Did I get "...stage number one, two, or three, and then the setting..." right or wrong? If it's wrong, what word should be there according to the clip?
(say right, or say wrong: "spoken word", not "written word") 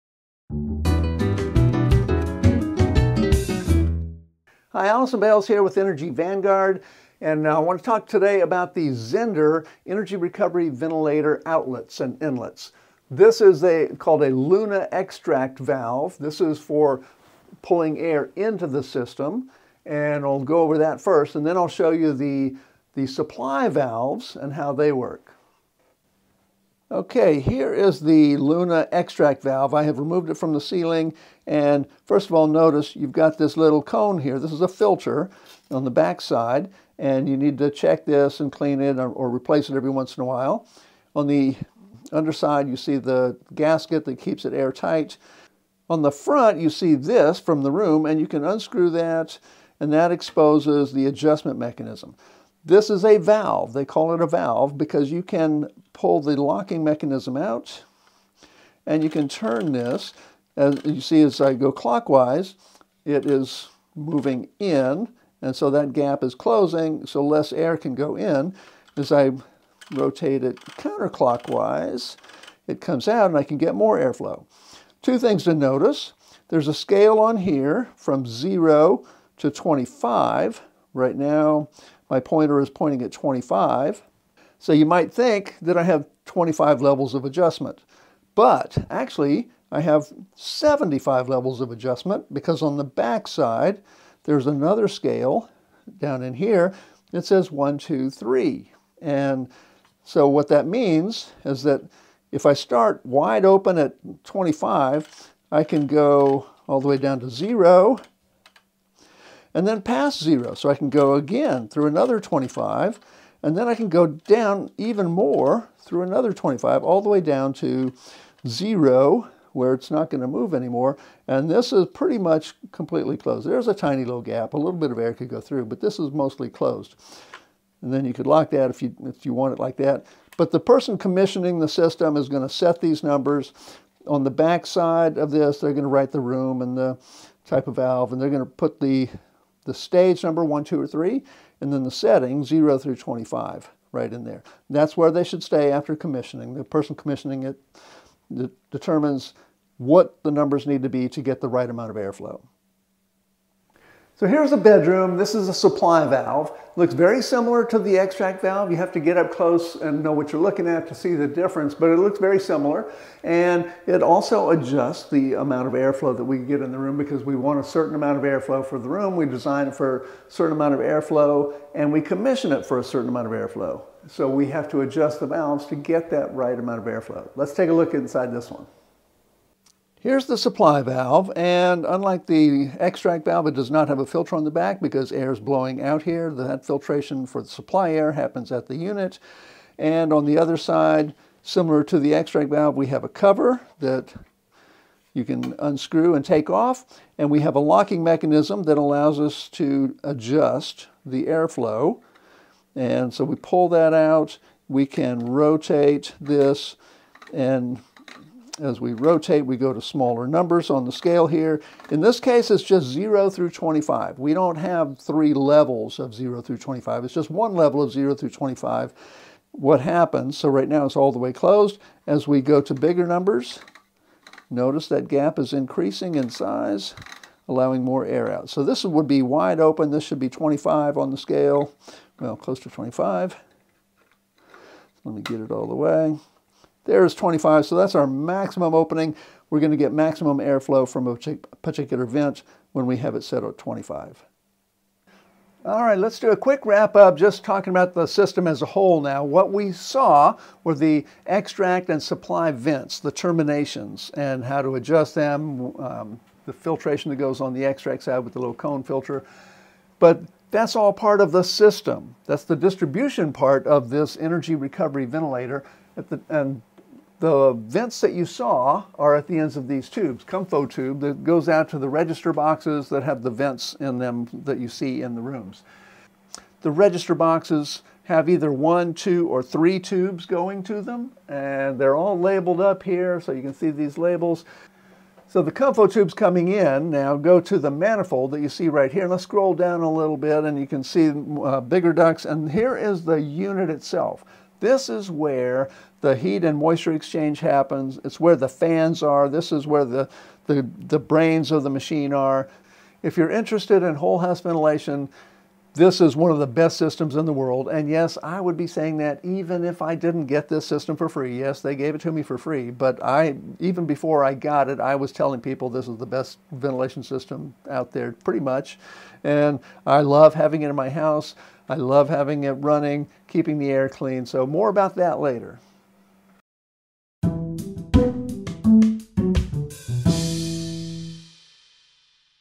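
right.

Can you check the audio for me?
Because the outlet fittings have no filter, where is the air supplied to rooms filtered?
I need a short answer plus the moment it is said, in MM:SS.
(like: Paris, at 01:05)
At the unit, at 03:08.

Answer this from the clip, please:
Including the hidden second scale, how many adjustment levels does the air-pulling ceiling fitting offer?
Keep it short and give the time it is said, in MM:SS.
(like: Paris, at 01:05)
75, at 01:30.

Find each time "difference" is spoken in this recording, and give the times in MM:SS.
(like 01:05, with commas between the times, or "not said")
02:41.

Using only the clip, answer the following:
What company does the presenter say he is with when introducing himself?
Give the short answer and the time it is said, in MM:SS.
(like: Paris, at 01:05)
Energy Vanguard, at 00:05.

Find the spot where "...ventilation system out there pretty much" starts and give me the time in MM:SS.
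05:16.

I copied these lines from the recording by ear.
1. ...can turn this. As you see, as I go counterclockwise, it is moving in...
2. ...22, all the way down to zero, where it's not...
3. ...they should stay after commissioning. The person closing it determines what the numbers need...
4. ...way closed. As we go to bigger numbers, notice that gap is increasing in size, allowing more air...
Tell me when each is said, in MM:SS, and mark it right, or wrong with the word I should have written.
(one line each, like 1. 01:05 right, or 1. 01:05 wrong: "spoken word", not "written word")
1. 00:59 wrong: "clockwise", not "counterclockwise"
2. 01:56 wrong: "25", not "22"
3. 02:25 wrong: "commissioning", not "closing"
4. 03:41 right.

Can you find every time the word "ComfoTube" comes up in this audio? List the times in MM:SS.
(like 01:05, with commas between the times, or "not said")
04:30, 04:45.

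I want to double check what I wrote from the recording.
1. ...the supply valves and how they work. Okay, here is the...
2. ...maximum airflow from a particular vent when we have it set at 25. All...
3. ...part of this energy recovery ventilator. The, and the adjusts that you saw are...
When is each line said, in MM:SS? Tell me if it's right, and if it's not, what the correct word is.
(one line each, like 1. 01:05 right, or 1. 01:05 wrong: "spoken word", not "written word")
1. 00:22 right
2. 03:59 right
3. 04:23 wrong: "vents", not "adjusts".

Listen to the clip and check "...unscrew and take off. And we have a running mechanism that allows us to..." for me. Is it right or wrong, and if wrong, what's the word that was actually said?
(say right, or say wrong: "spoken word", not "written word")
wrong: "locking", not "running".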